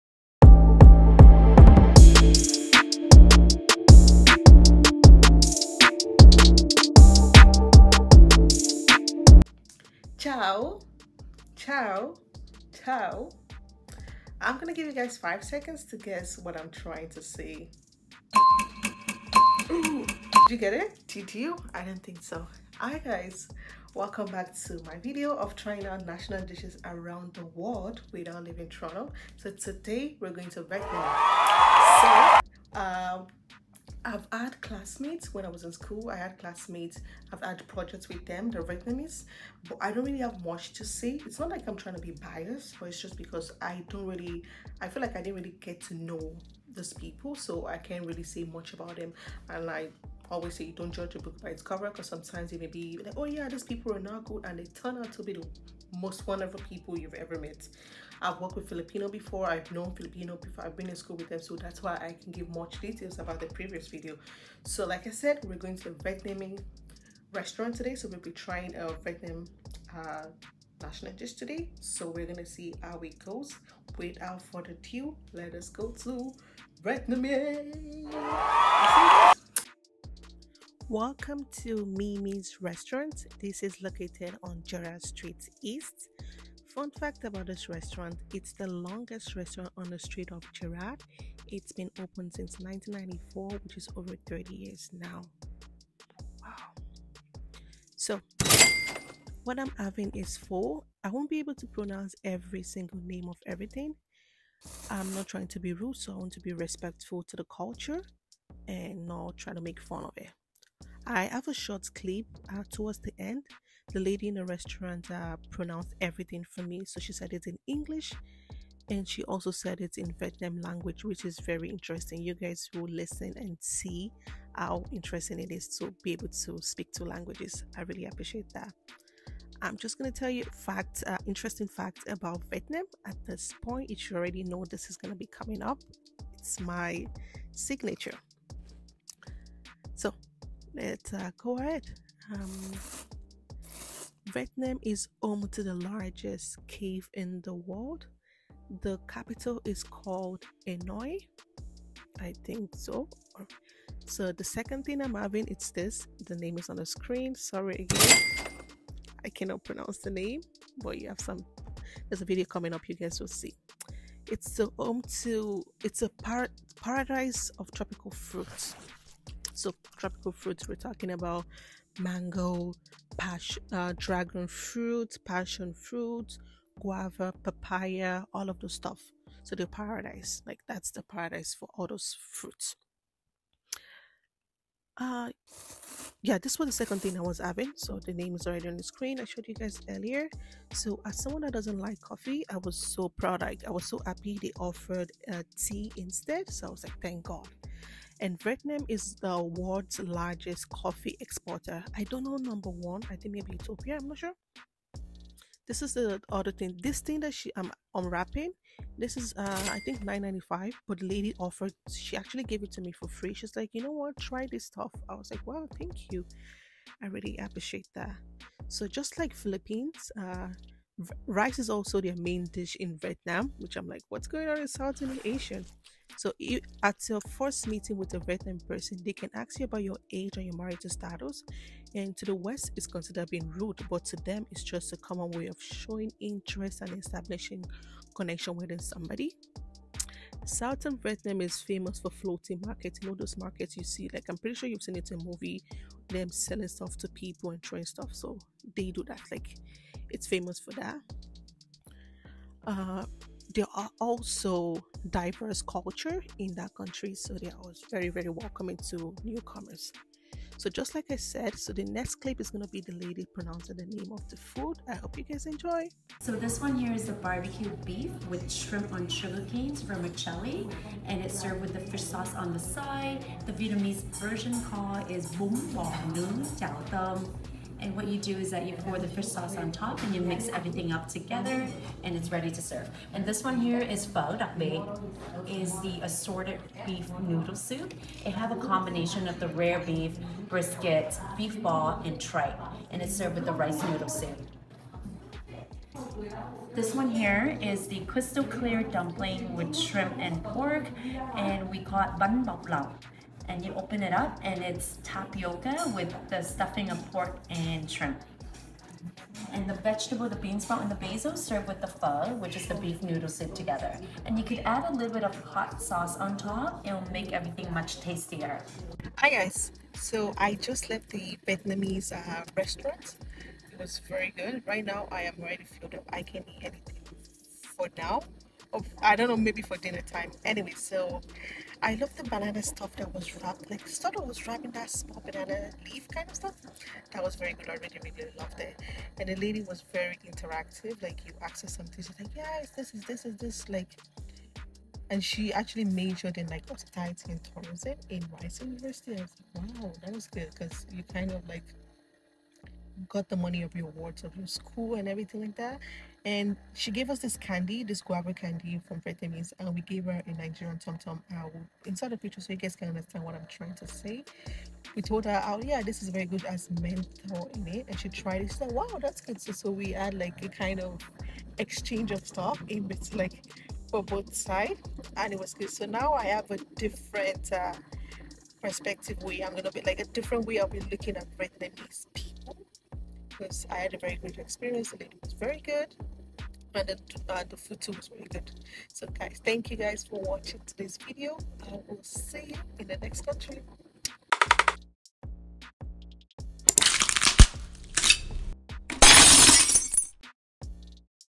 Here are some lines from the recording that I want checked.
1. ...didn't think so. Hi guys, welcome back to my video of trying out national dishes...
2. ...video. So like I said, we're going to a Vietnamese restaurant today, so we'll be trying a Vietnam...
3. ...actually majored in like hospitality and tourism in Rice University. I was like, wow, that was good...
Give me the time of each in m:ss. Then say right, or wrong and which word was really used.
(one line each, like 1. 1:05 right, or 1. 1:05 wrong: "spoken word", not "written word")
1. 0:21 right
2. 1:03 right
3. 5:45 right.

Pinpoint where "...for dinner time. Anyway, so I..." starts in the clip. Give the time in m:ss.
5:29.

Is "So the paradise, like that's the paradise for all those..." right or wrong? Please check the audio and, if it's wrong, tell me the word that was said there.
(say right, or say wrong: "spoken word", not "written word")
right.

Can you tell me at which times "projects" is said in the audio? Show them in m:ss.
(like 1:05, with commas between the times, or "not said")
0:37.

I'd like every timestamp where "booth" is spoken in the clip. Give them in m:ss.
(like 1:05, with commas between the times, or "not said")
not said.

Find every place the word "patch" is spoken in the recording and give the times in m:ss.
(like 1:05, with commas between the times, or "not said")
not said.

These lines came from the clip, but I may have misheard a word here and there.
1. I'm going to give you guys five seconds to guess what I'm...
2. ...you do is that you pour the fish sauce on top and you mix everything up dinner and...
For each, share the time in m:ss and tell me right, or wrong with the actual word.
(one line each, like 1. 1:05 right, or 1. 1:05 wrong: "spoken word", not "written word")
1. 0:14 right
2. 4:38 wrong: "together", not "dinner".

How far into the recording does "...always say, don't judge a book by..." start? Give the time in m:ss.
0:50.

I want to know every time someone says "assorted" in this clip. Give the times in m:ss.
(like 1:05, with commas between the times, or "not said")
4:46.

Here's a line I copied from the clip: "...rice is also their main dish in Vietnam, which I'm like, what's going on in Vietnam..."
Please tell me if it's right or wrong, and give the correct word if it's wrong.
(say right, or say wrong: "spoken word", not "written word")
wrong: "Southeast", not "Vietnam".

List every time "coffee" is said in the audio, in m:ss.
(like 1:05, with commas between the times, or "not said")
3:12, 3:20.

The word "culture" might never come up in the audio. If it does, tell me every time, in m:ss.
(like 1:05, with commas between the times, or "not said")
1:47, 4:15.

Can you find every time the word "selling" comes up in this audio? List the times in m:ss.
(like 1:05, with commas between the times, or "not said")
4:06.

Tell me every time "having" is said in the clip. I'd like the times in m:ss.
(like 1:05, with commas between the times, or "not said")
1:39, 2:35, 3:07.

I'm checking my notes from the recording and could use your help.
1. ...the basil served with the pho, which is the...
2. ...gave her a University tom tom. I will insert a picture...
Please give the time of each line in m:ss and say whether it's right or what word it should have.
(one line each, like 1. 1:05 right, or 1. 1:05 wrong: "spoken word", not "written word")
1. 5:10 right
2. 5:59 wrong: "Nigerian", not "University".